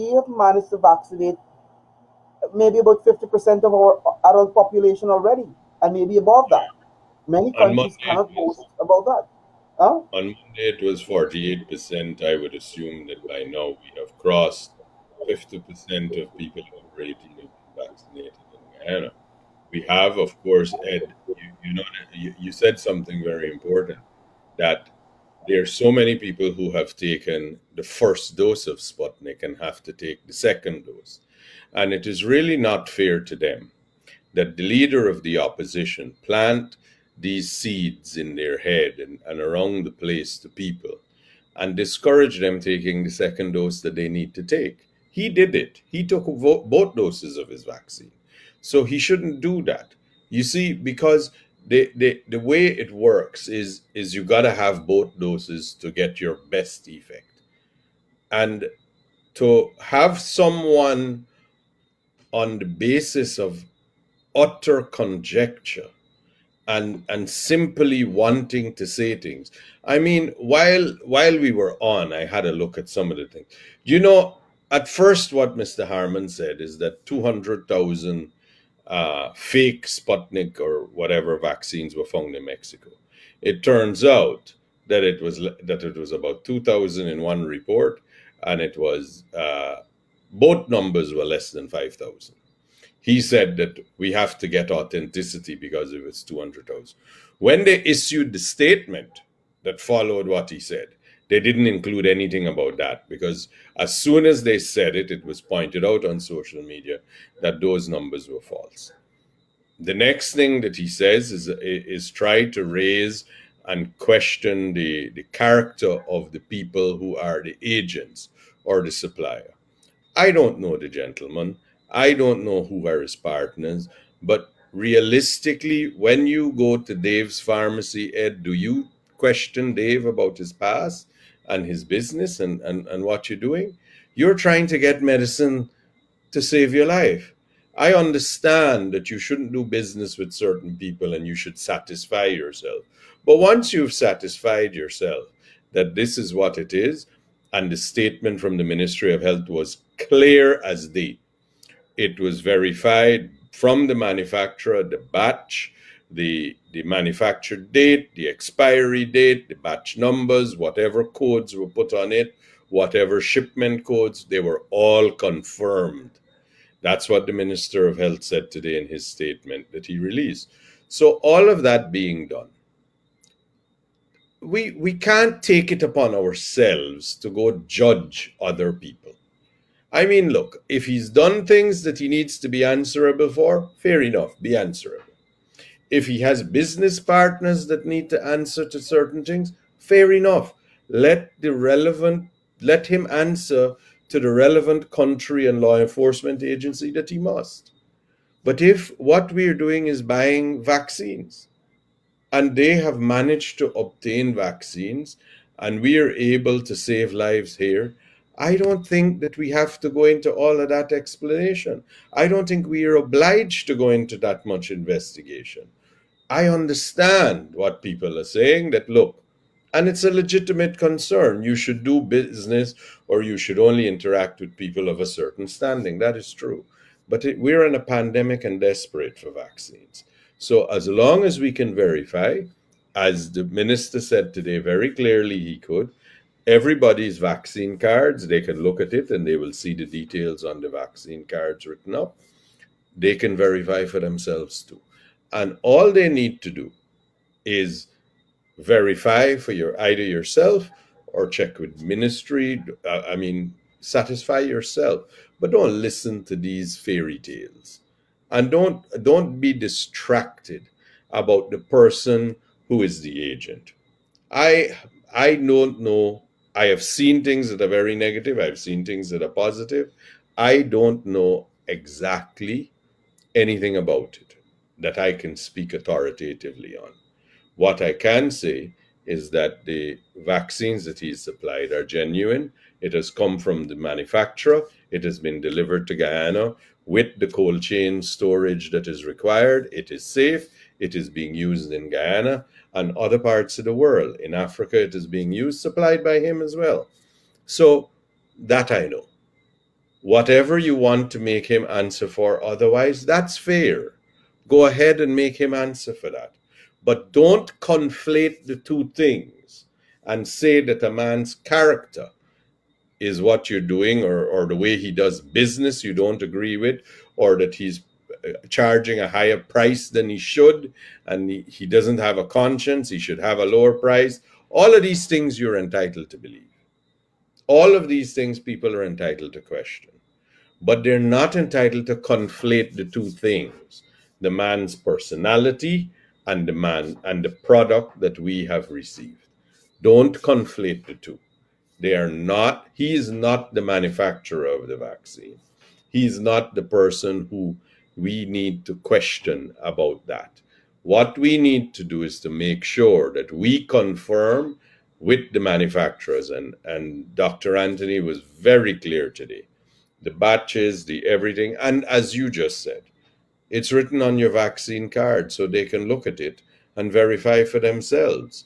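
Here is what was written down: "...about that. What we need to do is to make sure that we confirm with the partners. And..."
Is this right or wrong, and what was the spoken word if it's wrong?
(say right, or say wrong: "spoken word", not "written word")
wrong: "manufacturers", not "partners".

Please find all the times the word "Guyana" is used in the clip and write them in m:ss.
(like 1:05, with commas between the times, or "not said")
0:18, 4:45, 4:51.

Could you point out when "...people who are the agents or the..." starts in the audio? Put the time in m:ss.
1:56.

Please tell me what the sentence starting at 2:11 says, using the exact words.
and his business and, and, and what you're doing.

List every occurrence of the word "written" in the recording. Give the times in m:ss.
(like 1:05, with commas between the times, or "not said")
4:01, 6:03.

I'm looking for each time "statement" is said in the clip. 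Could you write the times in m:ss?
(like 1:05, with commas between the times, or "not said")
1:38, 2:27, 2:49.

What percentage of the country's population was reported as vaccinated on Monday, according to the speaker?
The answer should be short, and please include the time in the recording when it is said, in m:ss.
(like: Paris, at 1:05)
48%, at 0:11.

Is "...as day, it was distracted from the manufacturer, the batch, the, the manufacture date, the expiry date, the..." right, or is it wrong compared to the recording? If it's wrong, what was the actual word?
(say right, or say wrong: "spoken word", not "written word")
wrong: "verified", not "distracted".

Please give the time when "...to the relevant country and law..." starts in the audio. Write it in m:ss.
3:14.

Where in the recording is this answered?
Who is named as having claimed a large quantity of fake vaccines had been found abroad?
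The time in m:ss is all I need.
1:15.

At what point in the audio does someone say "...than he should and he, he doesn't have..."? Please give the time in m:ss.
5:19.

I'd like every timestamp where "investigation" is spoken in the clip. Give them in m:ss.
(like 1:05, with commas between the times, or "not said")
3:34.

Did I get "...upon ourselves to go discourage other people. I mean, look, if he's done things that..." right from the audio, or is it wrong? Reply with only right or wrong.
wrong.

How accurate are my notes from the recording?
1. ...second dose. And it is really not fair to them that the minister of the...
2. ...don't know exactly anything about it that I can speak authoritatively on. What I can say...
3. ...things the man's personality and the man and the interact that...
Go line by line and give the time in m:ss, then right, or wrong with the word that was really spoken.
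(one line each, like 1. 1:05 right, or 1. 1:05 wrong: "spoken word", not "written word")
1. 0:30 wrong: "leader", not "minister"
2. 4:30 right
3. 5:33 wrong: "product", not "interact".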